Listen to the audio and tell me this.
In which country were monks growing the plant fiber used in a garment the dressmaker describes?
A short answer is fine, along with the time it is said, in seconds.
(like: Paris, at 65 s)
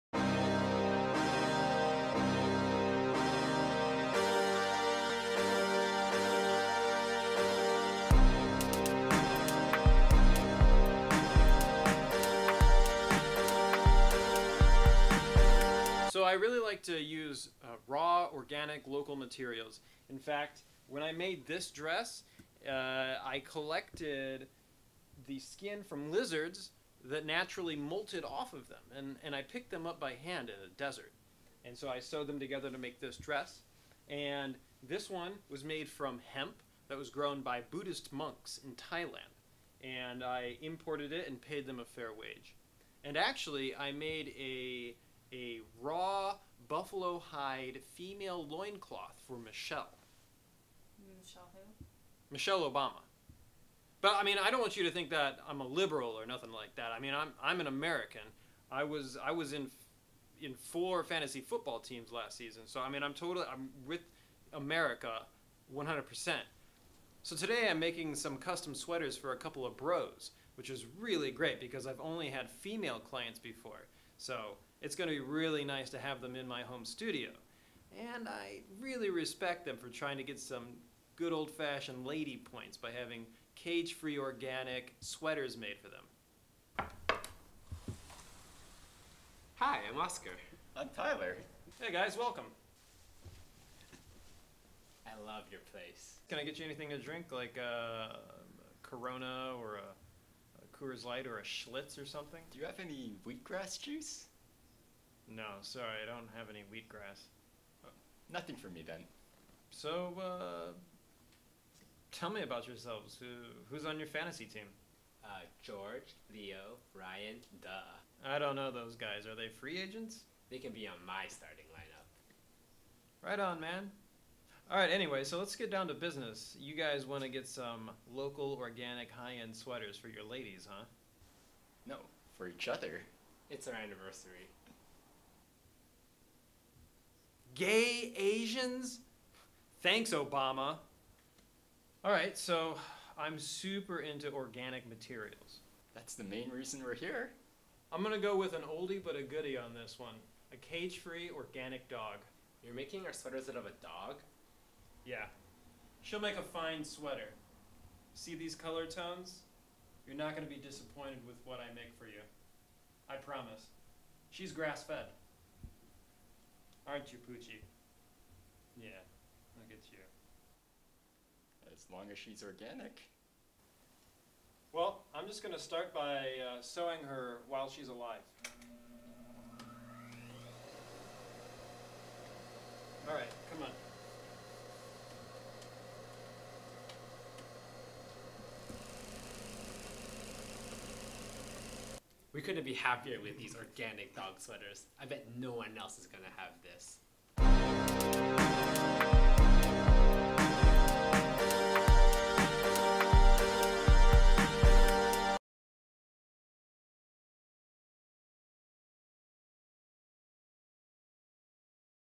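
Thailand, at 38 s.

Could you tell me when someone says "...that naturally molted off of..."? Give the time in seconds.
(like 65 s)
27 s.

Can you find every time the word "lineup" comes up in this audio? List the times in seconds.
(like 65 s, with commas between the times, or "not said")
121 s.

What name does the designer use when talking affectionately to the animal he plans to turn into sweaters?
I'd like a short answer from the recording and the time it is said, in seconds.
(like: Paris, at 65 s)
Poochie, at 167 s.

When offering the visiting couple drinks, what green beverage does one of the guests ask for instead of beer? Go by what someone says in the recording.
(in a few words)
Wheatgrass juice.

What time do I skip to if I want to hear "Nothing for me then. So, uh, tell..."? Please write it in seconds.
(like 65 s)
108 s.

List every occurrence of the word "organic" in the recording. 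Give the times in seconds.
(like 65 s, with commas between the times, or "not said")
18 s, 84 s, 128 s, 144 s, 151 s, 172 s, 193 s.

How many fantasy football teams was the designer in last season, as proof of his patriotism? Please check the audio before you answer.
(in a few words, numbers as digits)
4.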